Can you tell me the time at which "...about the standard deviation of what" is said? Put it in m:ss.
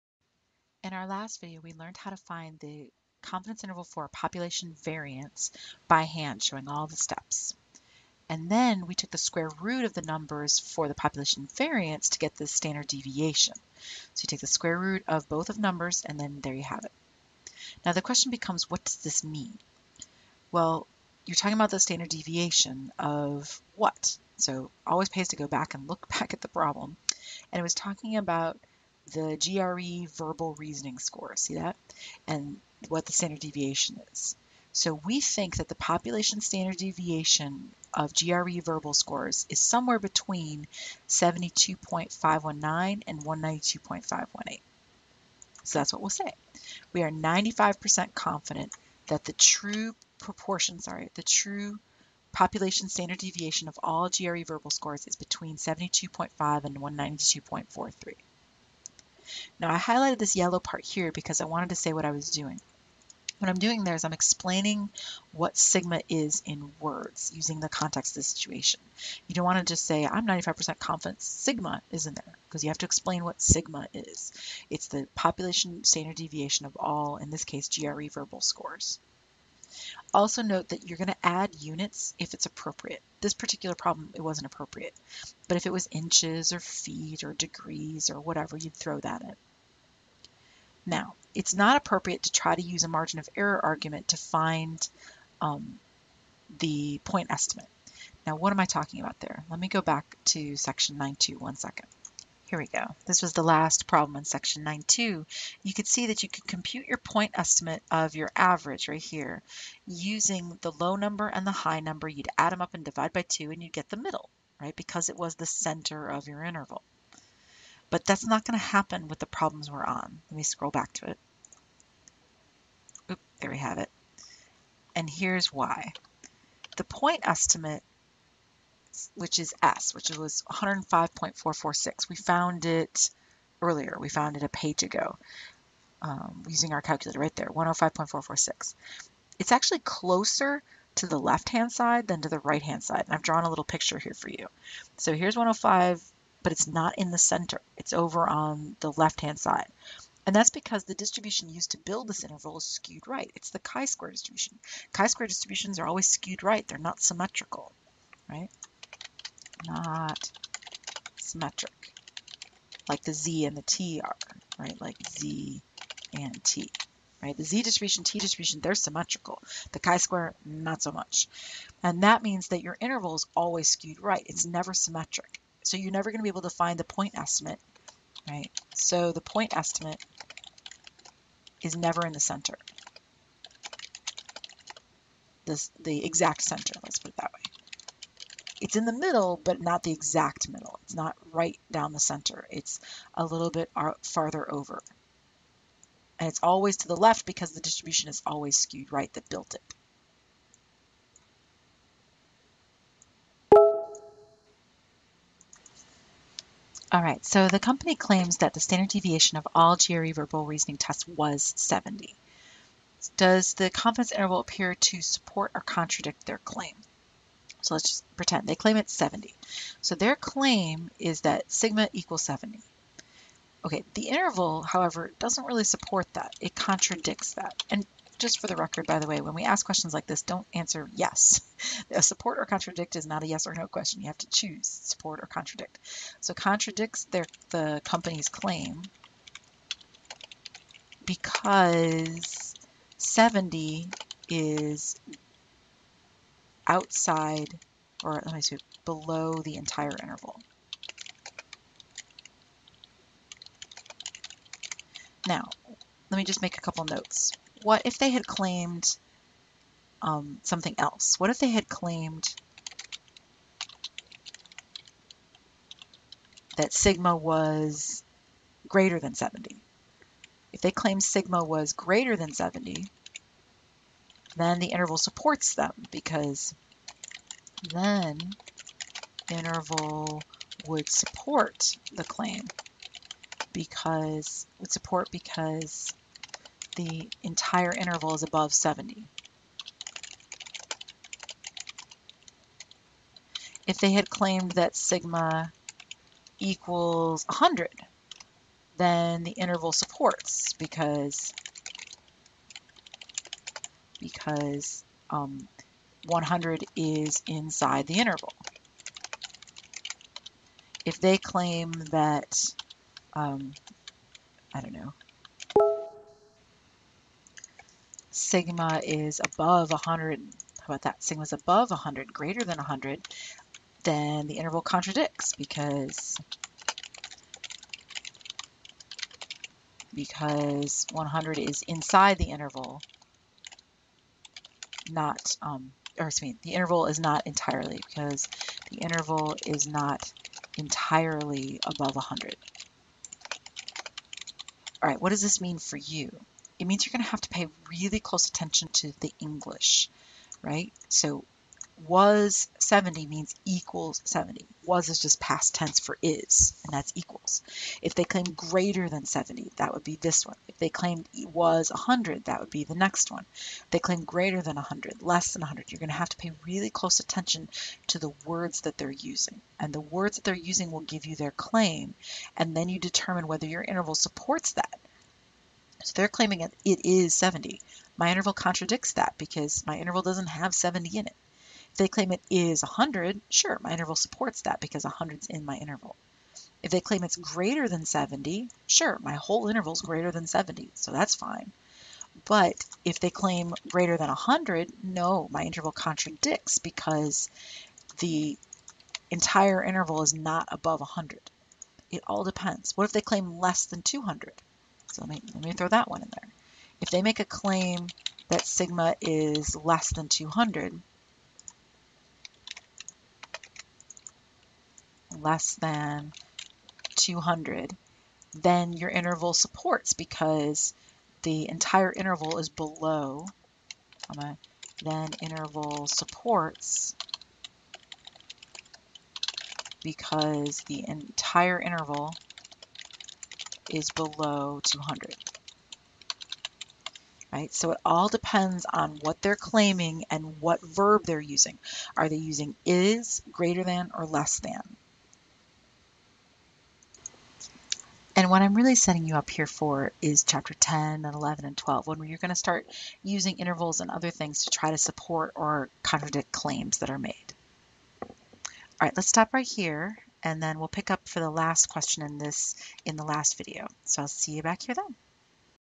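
0:21.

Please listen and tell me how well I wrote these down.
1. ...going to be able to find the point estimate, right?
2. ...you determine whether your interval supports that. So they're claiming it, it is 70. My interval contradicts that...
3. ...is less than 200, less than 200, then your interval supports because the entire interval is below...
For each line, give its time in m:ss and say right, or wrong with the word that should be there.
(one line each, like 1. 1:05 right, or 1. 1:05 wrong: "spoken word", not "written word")
1. 2:56 right
2. 6:12 right
3. 6:48 right.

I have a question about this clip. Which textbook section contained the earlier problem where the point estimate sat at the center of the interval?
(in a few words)
9.2.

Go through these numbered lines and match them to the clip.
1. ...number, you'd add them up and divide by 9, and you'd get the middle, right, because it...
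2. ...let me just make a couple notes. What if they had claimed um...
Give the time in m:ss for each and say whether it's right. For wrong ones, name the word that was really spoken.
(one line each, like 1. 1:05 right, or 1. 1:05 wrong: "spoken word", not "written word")
1. 1:51 wrong: "2", not "9"
2. 4:16 right.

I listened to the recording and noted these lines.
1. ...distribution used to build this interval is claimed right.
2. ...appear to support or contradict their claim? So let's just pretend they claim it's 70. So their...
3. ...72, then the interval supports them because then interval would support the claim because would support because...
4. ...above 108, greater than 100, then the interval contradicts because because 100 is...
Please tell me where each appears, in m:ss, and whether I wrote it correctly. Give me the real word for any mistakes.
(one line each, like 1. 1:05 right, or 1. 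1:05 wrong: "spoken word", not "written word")
1. 2:30 wrong: "skewed", not "claimed"
2. 3:34 right
3. 4:32 wrong: "70", not "72"
4. 5:21 wrong: "100", not "108".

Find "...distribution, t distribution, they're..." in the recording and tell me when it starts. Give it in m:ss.
2:47.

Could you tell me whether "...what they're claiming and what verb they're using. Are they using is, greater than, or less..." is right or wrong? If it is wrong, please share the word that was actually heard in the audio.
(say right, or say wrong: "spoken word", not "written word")
right.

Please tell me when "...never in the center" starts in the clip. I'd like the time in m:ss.
3:01.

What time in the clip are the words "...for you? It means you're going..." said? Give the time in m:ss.
5:45.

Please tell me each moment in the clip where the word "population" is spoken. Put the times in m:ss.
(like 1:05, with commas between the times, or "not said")
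0:04, 0:10, 0:35, 0:52, 1:15.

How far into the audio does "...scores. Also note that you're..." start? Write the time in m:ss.
1:18.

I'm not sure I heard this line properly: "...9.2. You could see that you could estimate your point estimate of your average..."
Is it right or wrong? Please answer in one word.
wrong.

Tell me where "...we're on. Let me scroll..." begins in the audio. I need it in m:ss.
1:59.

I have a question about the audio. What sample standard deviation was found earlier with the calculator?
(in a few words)
105.446.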